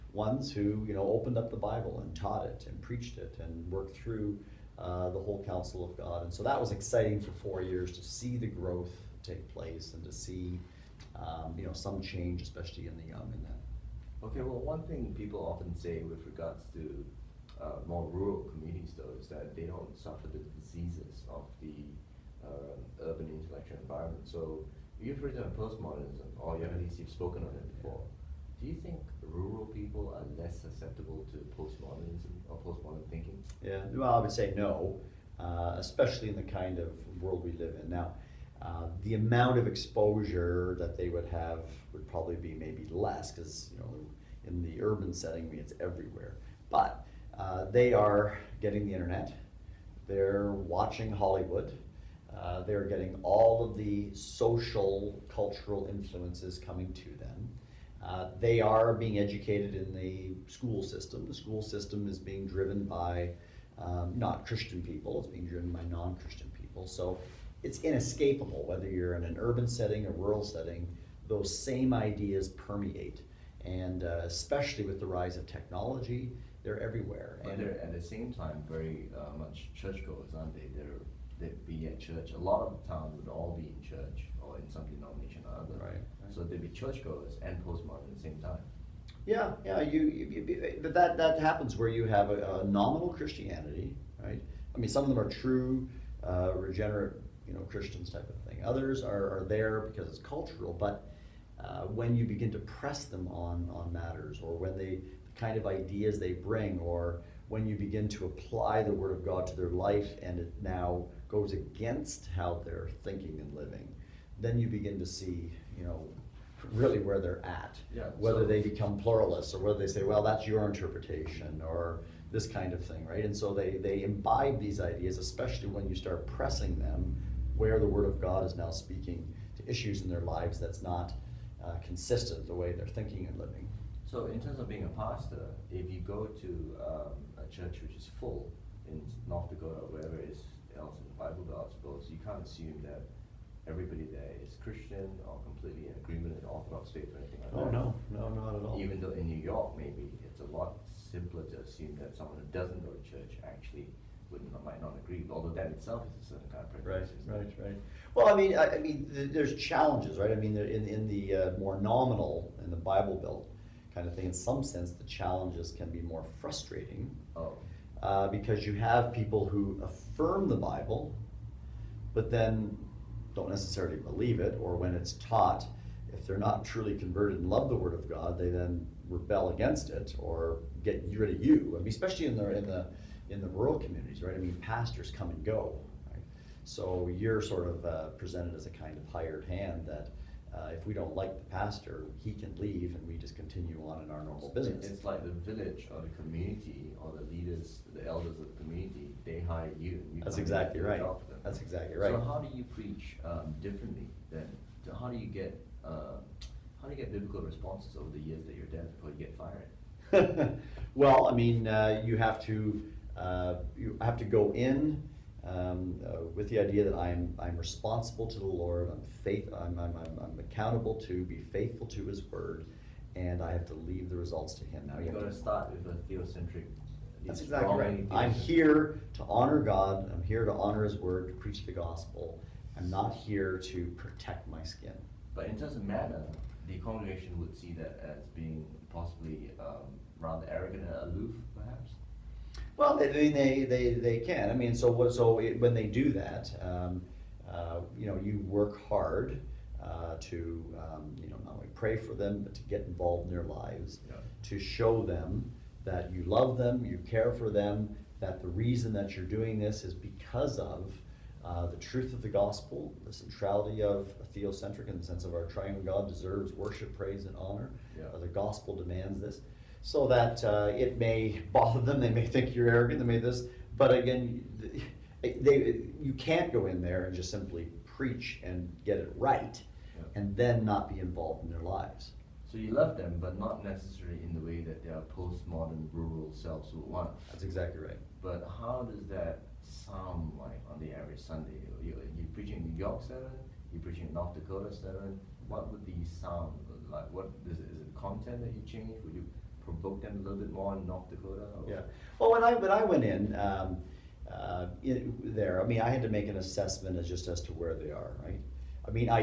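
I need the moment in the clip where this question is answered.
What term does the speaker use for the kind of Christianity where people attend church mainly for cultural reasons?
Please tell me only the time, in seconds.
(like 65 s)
92 s.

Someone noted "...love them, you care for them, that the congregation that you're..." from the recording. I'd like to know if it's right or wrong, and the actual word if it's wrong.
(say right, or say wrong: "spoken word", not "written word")
wrong: "reason", not "congregation".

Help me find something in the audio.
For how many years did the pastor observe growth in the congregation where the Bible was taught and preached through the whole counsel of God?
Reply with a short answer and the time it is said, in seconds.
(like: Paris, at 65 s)
4, at 7 s.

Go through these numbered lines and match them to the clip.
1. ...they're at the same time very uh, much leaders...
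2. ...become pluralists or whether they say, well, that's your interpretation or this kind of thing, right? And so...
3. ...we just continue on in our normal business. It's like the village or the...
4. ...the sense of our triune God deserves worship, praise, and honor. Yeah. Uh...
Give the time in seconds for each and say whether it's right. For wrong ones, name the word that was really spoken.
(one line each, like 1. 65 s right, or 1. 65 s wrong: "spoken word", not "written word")
1. 77 s wrong: "churchgoers", not "leaders"
2. 118 s right
3. 193 s right
4. 264 s right.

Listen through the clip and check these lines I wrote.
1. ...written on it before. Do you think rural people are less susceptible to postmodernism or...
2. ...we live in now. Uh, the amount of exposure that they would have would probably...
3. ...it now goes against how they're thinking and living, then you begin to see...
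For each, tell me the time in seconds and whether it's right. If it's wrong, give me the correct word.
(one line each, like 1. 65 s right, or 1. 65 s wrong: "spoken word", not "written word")
1. 27 s wrong: "spoken", not "written"
2. 37 s right
3. 110 s right.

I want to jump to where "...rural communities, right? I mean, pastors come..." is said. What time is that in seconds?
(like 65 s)
183 s.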